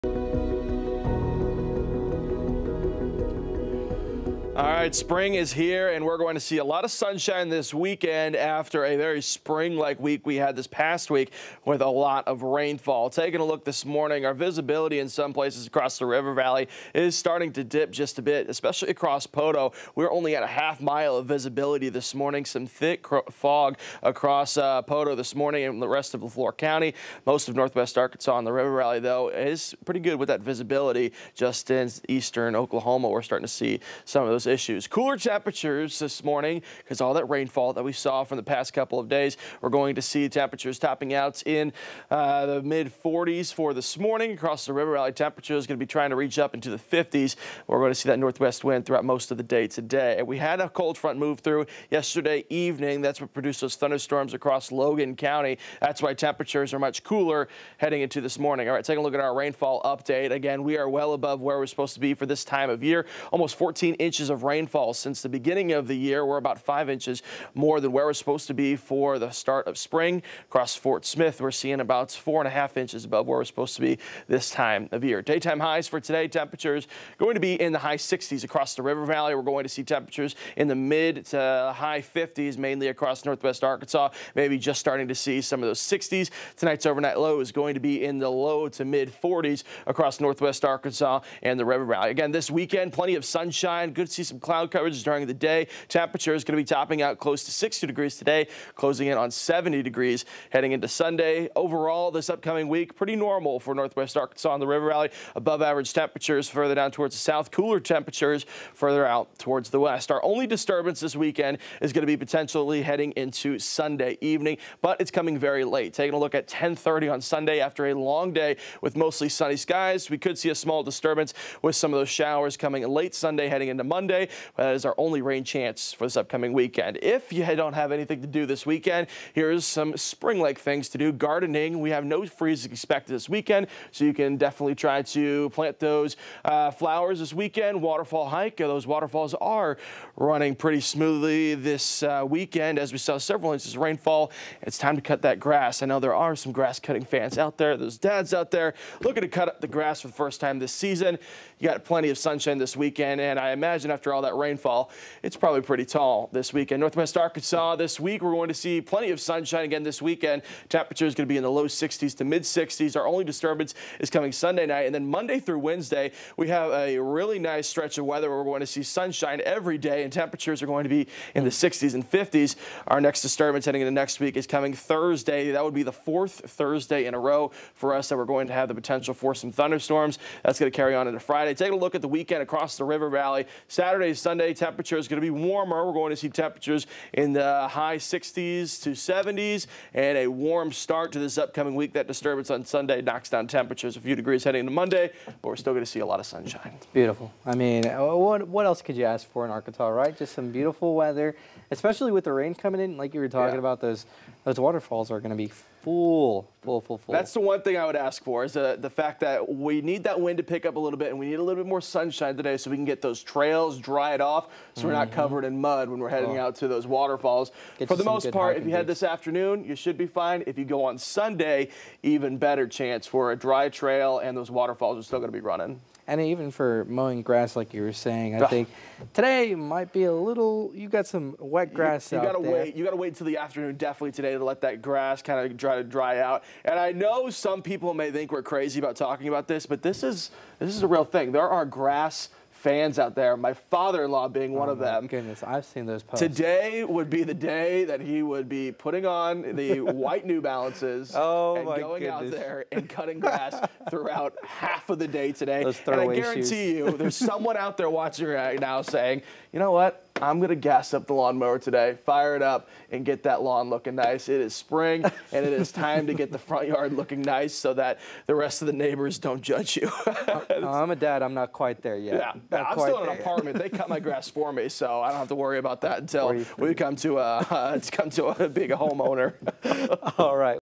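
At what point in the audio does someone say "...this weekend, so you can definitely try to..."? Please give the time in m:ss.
2:13.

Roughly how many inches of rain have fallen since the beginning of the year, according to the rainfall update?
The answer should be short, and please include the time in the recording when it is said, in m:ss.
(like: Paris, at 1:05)
Almost 14 inches, at 1:03.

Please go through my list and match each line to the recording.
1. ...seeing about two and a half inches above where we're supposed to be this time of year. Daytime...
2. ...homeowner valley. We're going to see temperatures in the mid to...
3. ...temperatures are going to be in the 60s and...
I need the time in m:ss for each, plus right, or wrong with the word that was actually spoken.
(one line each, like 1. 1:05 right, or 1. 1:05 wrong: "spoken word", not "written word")
1. 1:11 wrong: "four", not "two"
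2. 1:18 wrong: "river", not "homeowner"
3. 2:50 right.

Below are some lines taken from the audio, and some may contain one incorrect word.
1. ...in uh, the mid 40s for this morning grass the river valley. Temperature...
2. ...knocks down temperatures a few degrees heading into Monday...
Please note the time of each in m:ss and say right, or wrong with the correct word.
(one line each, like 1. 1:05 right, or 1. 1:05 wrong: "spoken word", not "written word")
1. 0:41 wrong: "across", not "grass"
2. 3:13 right.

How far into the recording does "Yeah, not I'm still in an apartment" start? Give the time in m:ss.
4:32.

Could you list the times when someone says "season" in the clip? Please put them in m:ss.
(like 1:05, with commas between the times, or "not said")
1:34, 2:30.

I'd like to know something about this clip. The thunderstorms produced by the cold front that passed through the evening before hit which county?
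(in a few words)
Logan County.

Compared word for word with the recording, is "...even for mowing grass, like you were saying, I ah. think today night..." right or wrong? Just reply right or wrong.
wrong.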